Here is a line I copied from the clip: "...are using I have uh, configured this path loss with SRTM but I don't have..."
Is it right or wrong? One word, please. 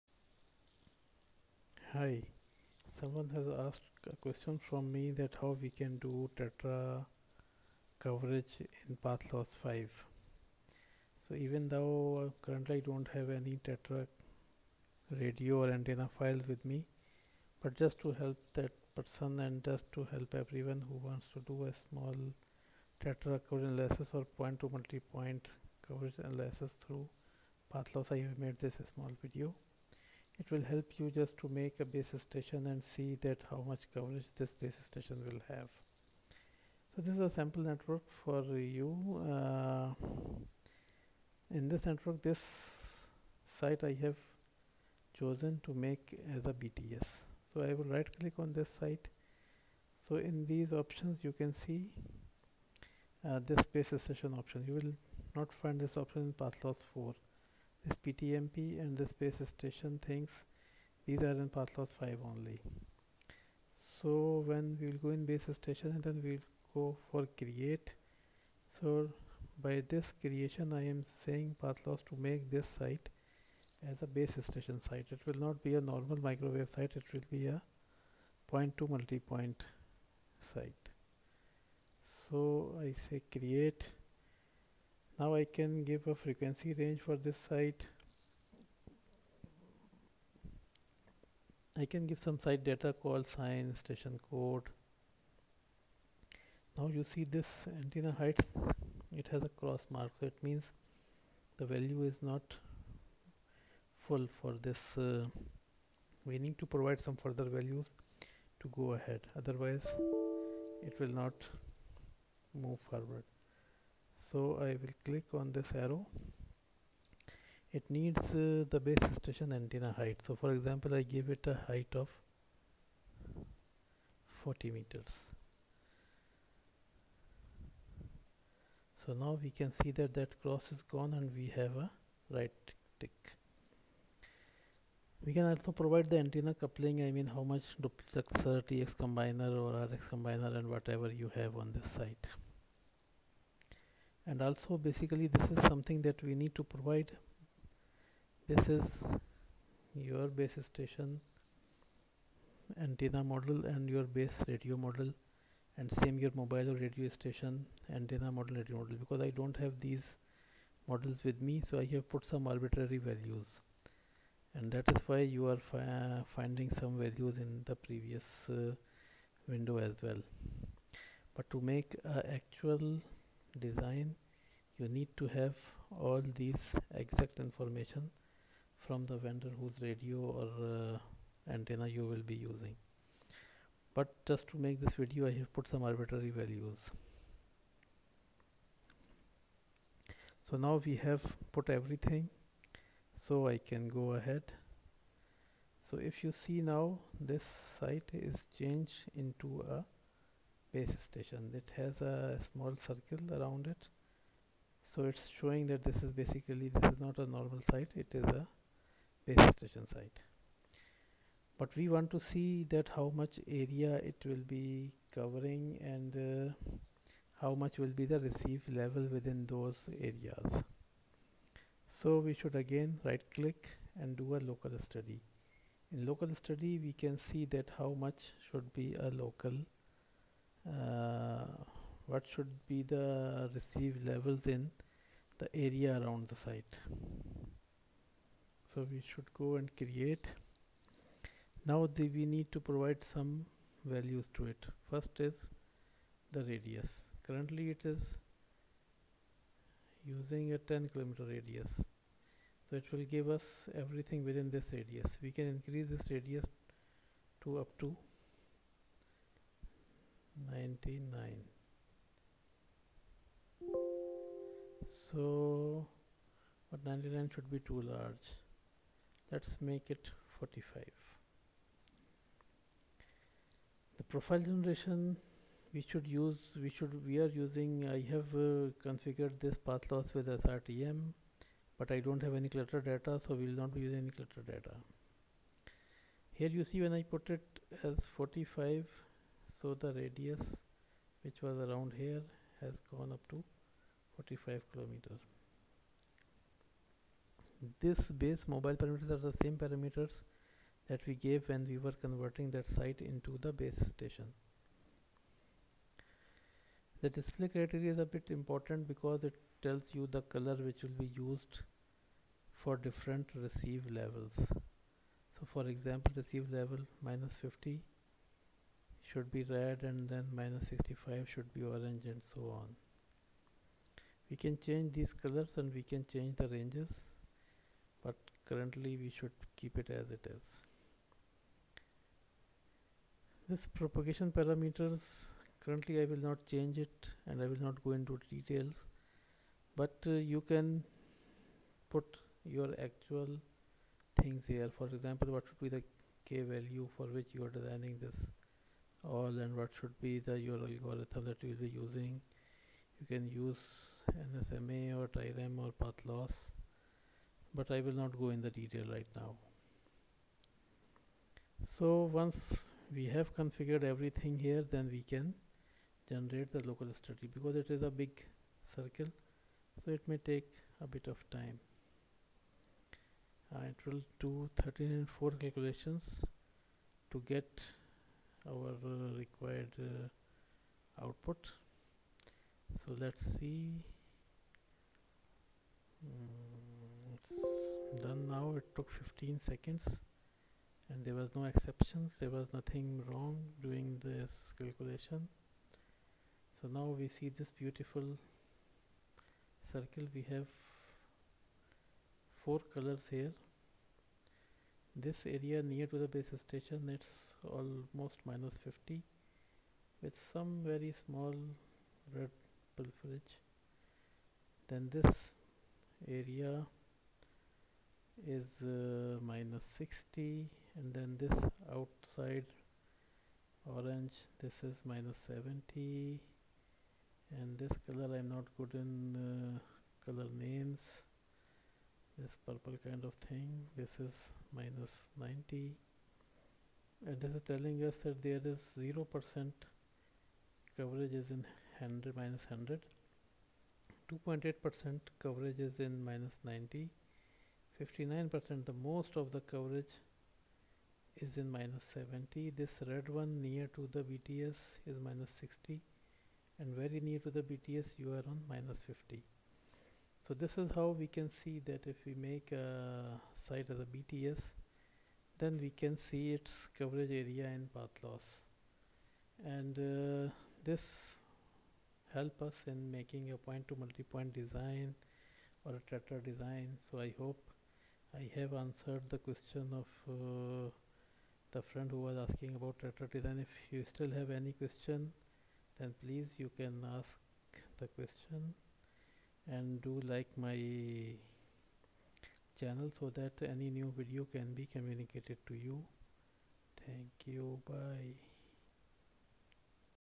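right.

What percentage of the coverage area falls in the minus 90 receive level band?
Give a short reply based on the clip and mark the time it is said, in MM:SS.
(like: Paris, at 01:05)
2.8 percent, at 07:24.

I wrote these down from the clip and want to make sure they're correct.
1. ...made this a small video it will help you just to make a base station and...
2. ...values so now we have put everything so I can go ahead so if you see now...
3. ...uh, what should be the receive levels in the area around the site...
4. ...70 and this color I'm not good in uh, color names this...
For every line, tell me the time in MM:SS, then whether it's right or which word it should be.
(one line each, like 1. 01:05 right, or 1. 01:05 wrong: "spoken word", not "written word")
1. 00:28 right
2. 03:06 right
3. 03:50 right
4. 07:05 right.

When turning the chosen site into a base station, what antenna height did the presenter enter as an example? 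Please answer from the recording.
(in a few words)
40 meters.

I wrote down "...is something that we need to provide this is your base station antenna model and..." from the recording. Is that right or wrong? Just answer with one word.
right.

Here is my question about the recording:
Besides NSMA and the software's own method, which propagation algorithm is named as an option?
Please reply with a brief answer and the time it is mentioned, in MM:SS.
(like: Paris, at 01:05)
TIREM, at 05:55.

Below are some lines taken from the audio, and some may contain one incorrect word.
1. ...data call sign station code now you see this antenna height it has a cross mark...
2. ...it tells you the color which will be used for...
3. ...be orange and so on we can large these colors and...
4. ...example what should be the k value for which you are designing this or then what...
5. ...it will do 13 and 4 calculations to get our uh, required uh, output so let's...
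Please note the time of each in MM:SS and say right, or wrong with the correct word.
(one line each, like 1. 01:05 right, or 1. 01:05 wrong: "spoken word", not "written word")
1. 01:32 right
2. 05:09 right
3. 05:21 wrong: "change", not "large"
4. 05:44 right
5. 06:13 right.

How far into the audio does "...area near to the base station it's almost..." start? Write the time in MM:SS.
06:45.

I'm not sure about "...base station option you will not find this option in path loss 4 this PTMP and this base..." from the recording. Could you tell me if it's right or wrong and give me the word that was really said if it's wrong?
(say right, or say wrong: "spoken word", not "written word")
right.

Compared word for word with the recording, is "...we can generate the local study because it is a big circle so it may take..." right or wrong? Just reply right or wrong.
right.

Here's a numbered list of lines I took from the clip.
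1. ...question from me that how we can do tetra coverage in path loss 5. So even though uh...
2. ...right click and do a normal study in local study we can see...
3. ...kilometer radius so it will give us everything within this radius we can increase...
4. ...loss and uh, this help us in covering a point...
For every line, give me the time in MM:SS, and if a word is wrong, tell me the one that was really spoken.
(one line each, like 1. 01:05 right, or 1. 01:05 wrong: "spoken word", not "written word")
1. 00:04 right
2. 03:43 wrong: "local", not "normal"
3. 04:10 right
4. 07:48 wrong: "making", not "covering".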